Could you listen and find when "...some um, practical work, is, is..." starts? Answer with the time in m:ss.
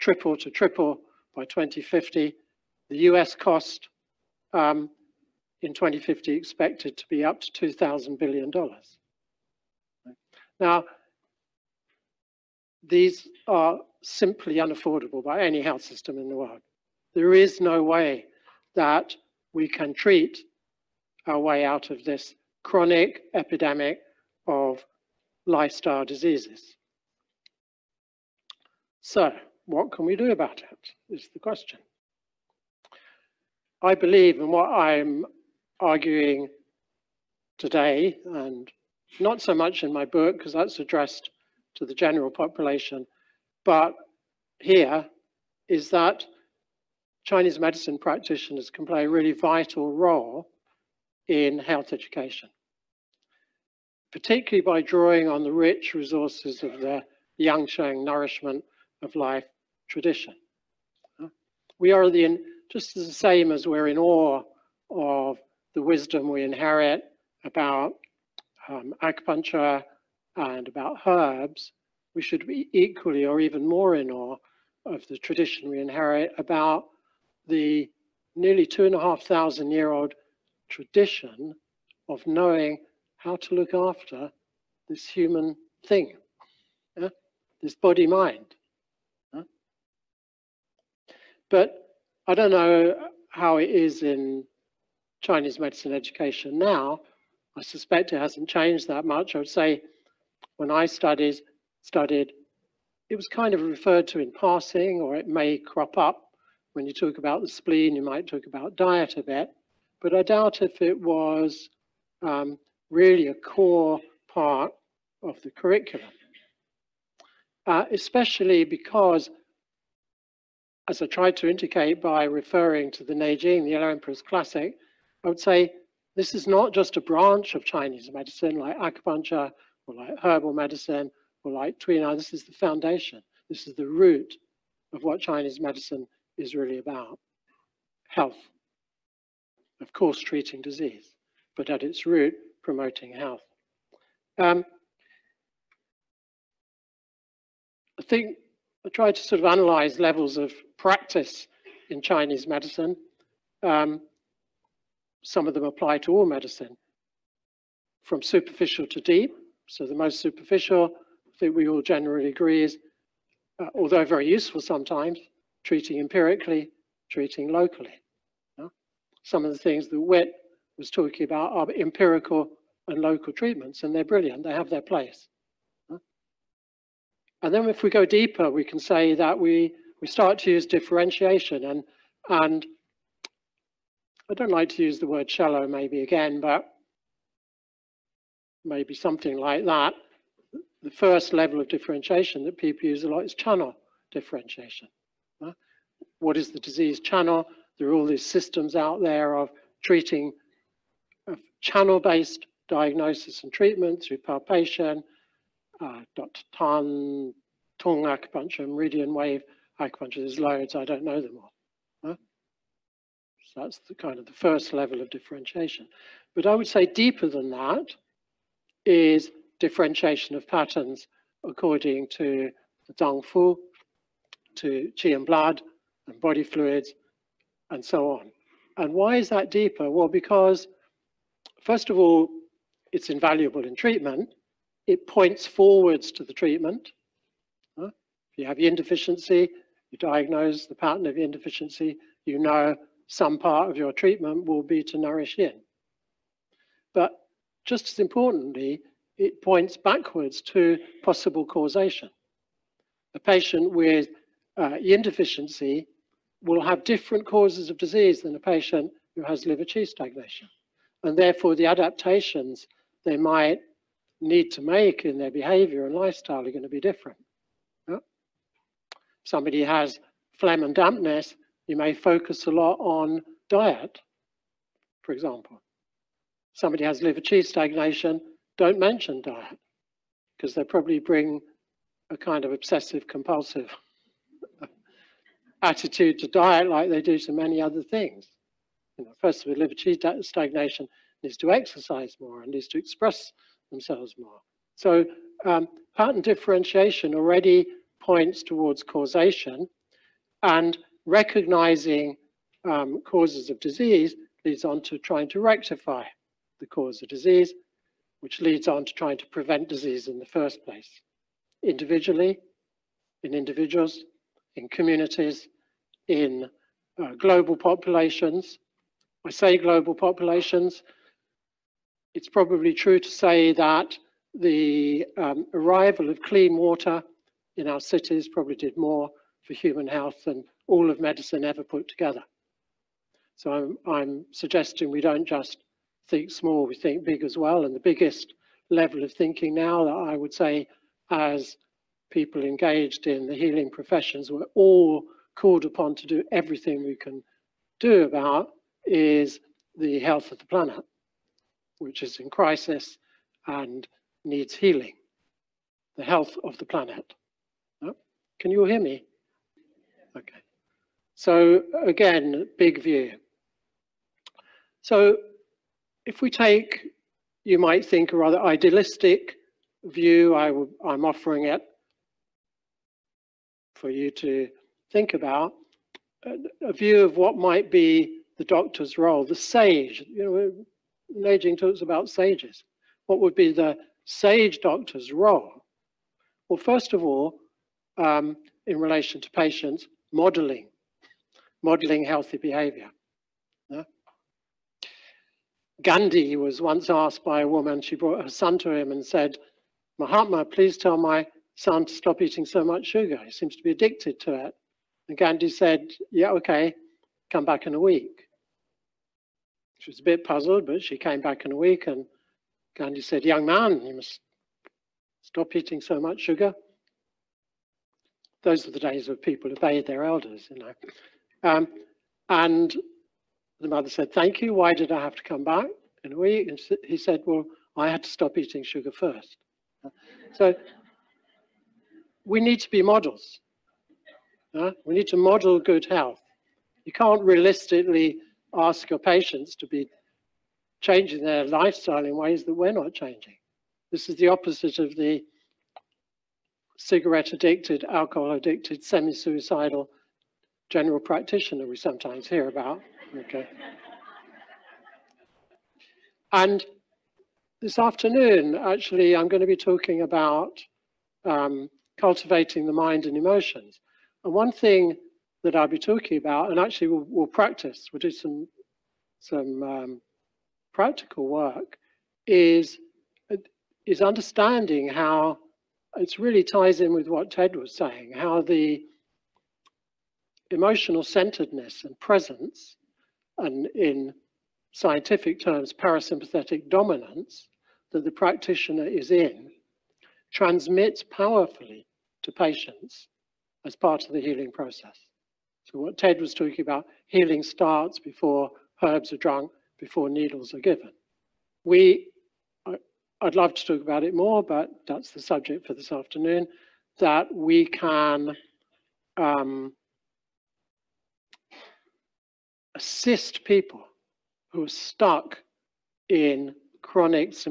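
7:49.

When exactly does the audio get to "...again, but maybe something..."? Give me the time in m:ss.
3:06.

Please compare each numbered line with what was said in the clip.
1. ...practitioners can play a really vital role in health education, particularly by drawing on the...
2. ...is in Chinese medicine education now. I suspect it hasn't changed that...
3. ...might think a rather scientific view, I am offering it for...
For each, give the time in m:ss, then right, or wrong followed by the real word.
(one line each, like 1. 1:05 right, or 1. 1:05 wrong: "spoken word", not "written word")
1. 0:47 right
2. 1:33 right
3. 6:07 wrong: "idealistic", not "scientific".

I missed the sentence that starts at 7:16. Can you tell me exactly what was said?
You can't realistically ask your patients to be changing their lifestyle in ways that we're not changing.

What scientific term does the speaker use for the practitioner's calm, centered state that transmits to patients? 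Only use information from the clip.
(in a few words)
parasympathetic dominance.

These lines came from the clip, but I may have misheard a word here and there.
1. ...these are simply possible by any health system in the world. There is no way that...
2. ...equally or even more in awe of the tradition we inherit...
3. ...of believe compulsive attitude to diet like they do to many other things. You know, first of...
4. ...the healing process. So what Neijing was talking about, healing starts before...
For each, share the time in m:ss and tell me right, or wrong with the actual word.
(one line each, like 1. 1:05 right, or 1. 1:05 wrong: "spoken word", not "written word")
1. 0:12 wrong: "unaffordable", not "possible"
2. 1:12 right
3. 4:42 wrong: "obsessive", not "believe"
4. 8:14 wrong: "Ted", not "Neijing".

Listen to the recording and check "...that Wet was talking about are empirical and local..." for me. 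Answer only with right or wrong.
right.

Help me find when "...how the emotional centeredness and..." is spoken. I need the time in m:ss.
7:58.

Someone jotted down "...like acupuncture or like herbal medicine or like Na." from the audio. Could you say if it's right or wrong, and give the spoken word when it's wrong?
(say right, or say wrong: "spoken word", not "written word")
right.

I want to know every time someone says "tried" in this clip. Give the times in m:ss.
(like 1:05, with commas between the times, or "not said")
2:01, 2:28.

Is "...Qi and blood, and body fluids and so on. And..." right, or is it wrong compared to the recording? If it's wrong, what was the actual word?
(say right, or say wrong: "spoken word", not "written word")
right.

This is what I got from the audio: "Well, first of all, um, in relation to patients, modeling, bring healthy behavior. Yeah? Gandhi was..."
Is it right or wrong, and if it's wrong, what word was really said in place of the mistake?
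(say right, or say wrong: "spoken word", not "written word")
wrong: "modeling", not "bring".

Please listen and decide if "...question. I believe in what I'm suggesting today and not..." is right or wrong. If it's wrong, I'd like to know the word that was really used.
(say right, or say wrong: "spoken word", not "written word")
wrong: "arguing", not "suggesting".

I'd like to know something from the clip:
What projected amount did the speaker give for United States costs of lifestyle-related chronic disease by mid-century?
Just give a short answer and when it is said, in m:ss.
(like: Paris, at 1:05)
$2,000 billion, at 0:07.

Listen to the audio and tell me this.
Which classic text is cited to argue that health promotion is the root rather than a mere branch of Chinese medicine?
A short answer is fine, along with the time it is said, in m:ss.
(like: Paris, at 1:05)
Yellow Emperor's Classic, at 2:03.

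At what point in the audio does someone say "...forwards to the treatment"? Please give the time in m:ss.
3:55.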